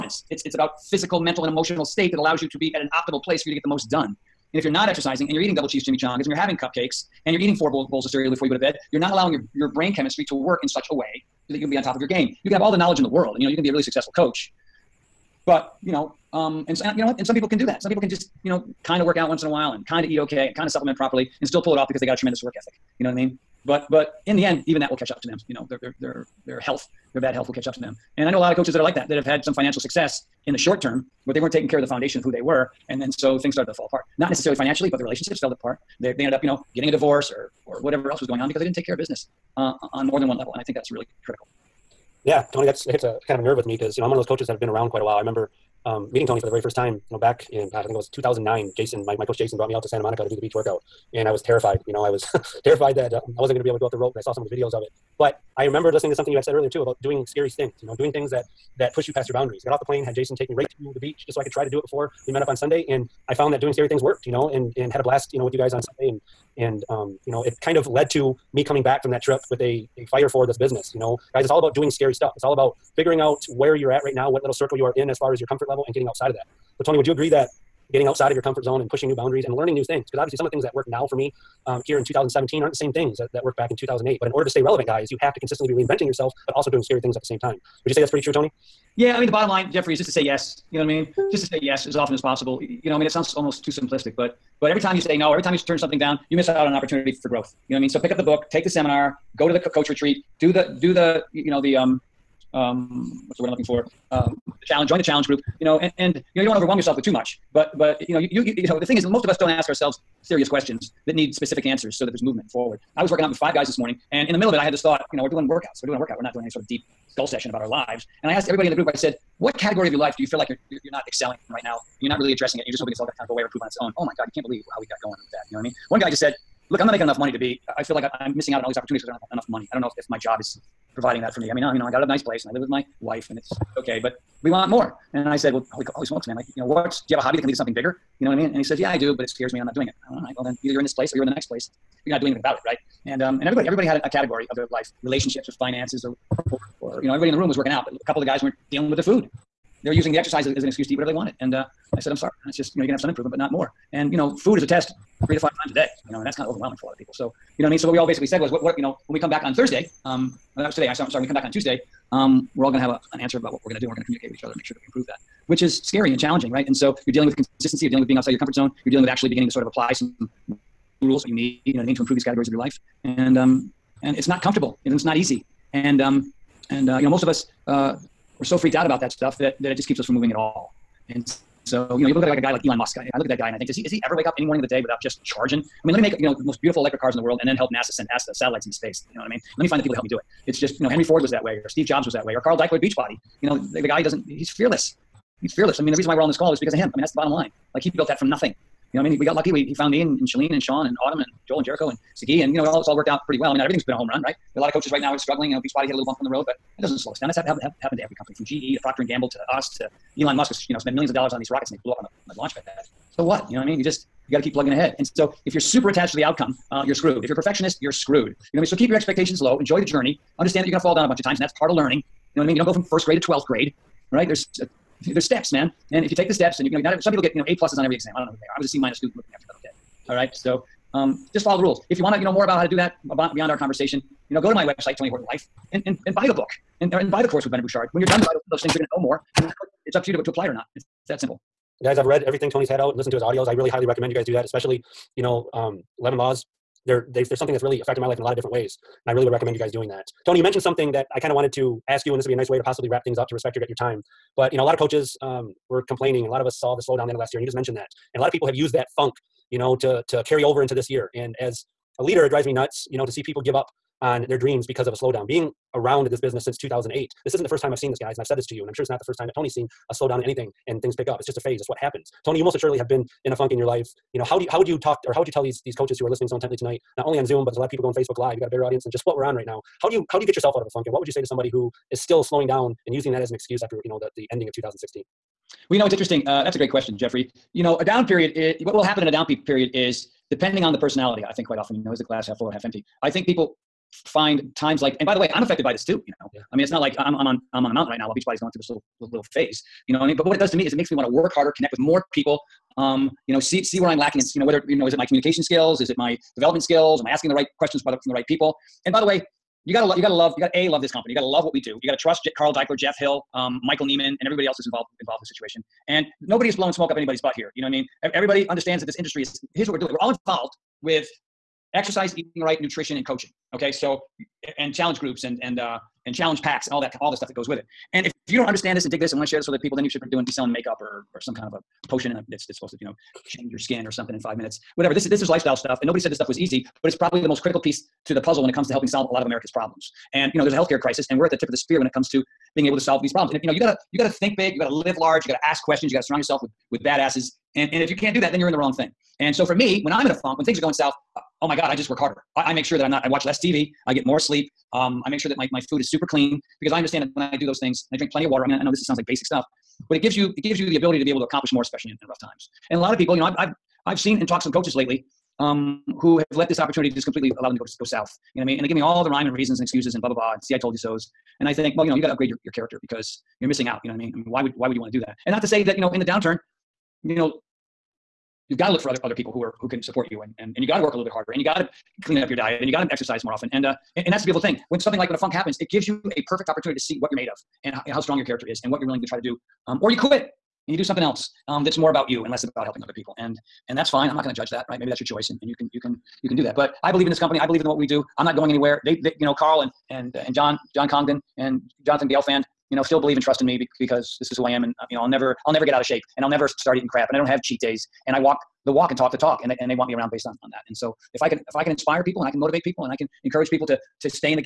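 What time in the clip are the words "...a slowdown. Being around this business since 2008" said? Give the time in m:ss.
4:24.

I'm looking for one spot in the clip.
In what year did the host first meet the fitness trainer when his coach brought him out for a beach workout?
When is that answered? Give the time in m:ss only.
0:48.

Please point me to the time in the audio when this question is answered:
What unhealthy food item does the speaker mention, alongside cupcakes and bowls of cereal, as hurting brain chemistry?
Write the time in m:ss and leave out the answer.
0:05.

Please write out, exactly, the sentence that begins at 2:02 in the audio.
And you're not really addressing it.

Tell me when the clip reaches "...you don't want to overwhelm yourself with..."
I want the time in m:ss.
1:46.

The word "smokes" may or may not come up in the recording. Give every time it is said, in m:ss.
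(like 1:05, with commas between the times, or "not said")
2:16, 5:16.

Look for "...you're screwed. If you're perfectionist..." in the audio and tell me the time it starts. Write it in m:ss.
3:36.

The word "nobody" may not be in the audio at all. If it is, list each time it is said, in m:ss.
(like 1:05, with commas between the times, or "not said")
5:16, 5:35.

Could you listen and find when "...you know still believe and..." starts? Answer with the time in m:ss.
6:42.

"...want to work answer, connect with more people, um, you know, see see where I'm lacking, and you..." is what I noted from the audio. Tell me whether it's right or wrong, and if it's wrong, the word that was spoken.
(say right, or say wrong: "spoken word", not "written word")
wrong: "harder", not "answer".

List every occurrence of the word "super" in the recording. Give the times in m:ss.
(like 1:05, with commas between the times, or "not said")
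3:35, 5:55.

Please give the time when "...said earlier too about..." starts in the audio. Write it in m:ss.
0:56.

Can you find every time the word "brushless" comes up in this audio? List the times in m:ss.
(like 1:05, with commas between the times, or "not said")
not said.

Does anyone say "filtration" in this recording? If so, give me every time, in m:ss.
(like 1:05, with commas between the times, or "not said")
not said.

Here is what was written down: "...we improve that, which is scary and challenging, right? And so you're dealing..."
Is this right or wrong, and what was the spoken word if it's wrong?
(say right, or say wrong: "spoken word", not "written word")
right.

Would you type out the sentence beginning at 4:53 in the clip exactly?
I think people find times like, and by the way, I'm affected by this too, you know.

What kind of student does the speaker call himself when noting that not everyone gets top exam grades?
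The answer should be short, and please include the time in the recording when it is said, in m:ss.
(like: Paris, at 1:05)
C minus, at 3:48.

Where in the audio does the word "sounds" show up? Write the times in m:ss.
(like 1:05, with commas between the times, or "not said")
1:33, 5:58.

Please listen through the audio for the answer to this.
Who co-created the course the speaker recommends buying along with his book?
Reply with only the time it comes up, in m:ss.
3:57.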